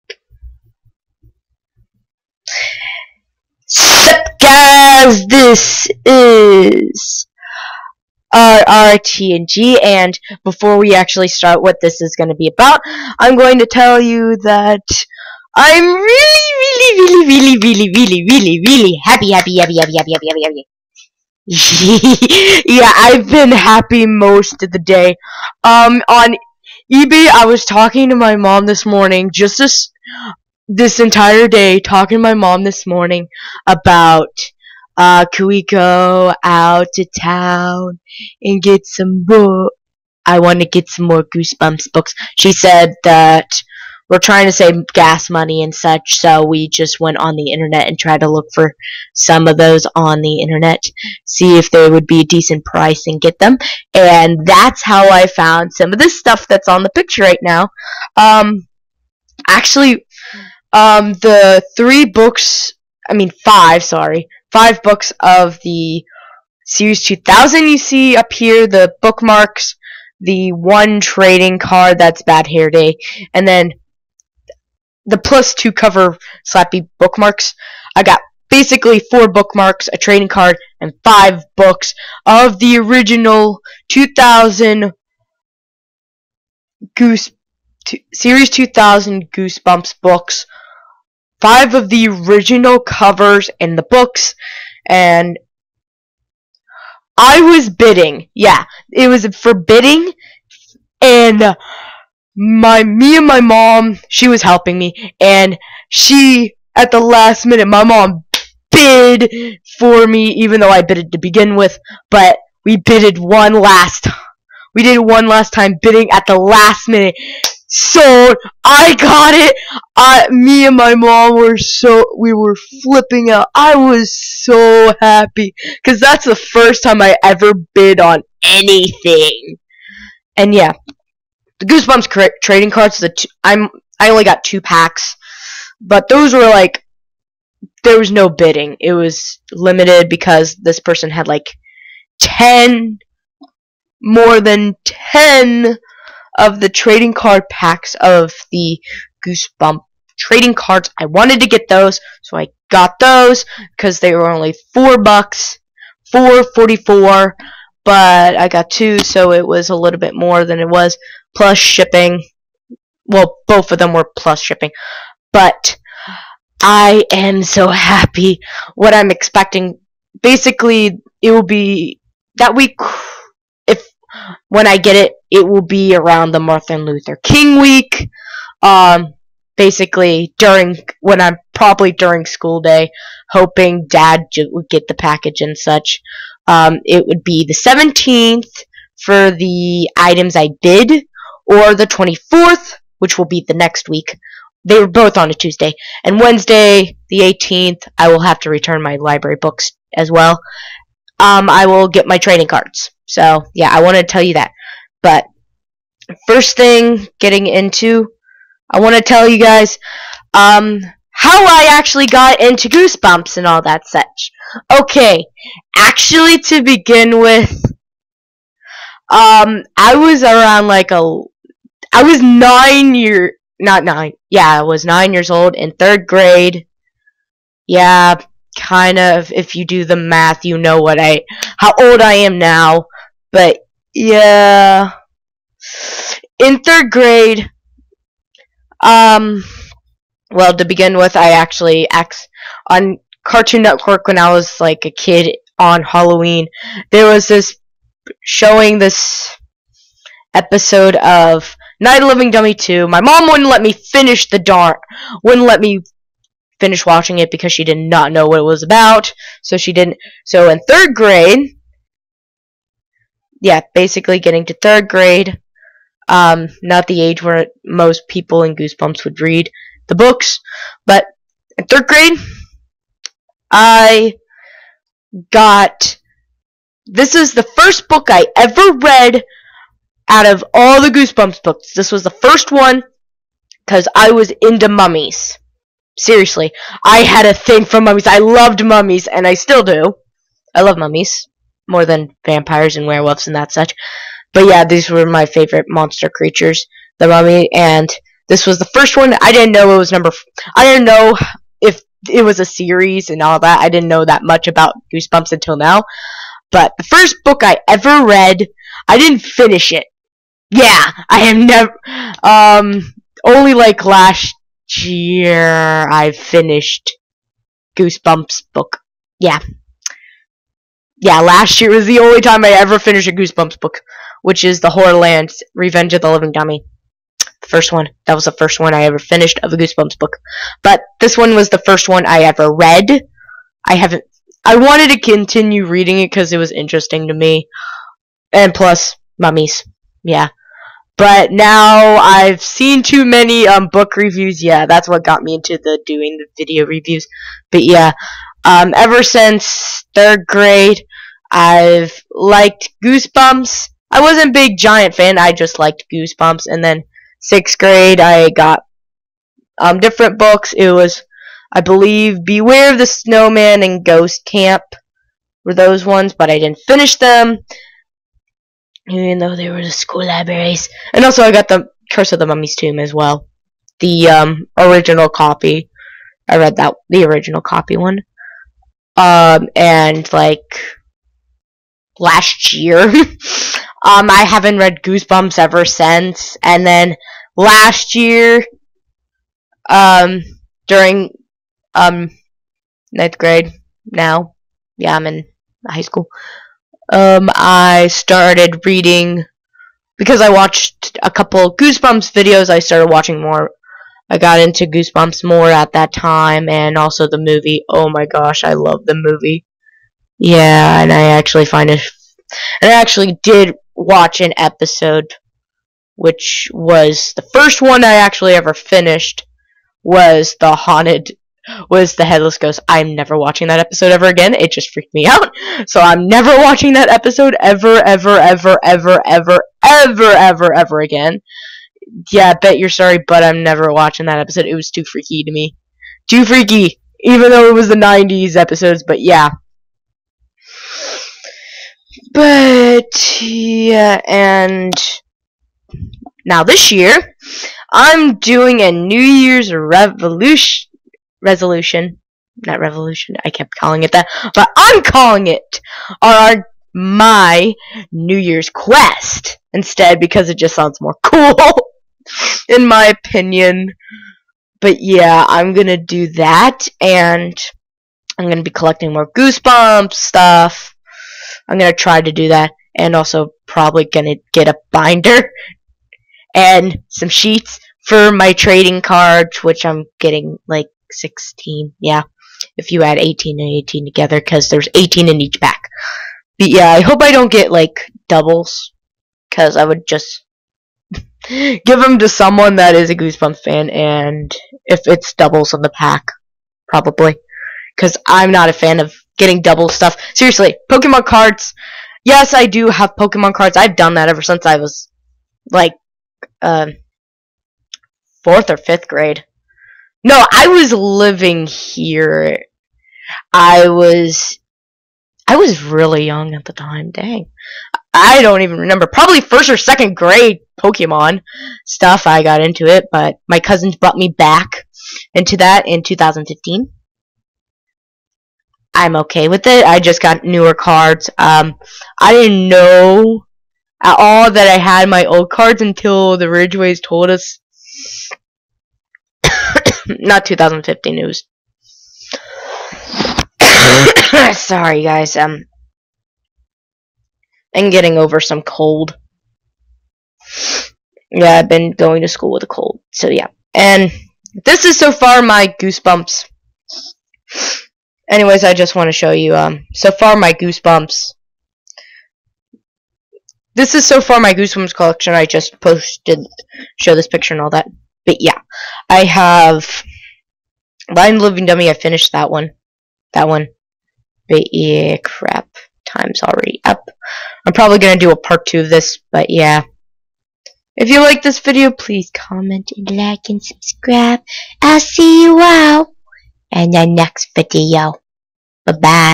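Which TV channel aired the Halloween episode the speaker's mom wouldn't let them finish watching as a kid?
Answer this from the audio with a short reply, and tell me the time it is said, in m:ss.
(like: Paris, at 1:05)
Cartoon Network, at 4:03.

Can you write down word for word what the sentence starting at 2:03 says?
I was so happy because that's the first time I ever bid on anything.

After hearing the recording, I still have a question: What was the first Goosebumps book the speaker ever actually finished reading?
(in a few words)
Revenge of the Living Dummy.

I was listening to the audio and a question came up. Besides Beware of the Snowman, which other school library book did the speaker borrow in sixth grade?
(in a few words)
Ghost Camp.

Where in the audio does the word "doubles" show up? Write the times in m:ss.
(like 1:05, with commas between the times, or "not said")
8:08, 8:15, 8:19.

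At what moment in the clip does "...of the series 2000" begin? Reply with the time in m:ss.
1:05.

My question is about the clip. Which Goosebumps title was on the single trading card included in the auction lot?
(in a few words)
Bad Hair Day.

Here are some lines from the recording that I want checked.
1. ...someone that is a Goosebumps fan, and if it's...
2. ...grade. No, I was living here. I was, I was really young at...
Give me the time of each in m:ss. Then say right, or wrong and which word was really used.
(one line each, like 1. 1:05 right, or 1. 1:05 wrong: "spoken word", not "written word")
1. 8:12 right
2. 8:28 right.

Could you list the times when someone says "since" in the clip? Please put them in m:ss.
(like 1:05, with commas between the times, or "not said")
5:49, 6:25, 8:24.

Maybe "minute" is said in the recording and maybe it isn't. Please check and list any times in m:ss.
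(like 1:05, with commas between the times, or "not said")
1:47, 1:56.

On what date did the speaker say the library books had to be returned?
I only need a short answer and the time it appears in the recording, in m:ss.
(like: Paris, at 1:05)
18th, at 3:17.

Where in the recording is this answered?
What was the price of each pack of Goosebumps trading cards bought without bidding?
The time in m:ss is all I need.
2:36.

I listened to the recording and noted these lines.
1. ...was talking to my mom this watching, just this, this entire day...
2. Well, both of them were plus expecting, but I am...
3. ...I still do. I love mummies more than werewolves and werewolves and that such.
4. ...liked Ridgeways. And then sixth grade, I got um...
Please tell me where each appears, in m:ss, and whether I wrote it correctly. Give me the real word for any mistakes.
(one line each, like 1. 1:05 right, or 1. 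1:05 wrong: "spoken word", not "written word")
1. 0:27 wrong: "morning", not "watching"
2. 2:43 wrong: "shipping", not "expecting"
3. 4:49 wrong: "vampires", not "werewolves"
4. 5:55 wrong: "Goosebumps", not "Ridgeways".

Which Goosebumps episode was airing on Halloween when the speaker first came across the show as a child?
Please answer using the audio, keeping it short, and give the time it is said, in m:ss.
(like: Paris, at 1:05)
Night of the Living Dummy 2, at 4:11.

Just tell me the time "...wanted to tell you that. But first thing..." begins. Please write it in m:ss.
3:23.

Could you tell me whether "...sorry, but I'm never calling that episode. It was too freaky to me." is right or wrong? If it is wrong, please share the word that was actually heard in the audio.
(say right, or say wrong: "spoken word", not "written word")
wrong: "watching", not "calling".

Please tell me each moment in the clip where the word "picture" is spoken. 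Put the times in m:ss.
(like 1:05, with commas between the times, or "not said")
0:56, 9:27.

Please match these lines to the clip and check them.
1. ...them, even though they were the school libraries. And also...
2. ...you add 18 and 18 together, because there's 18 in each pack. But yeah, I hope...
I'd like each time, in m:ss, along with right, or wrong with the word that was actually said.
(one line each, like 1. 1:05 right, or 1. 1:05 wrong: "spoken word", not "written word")
1. 6:06 right
2. 8:02 right.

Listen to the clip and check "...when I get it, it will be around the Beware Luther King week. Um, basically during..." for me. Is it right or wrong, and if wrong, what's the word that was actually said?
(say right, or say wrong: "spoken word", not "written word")
wrong: "Martin", not "Beware".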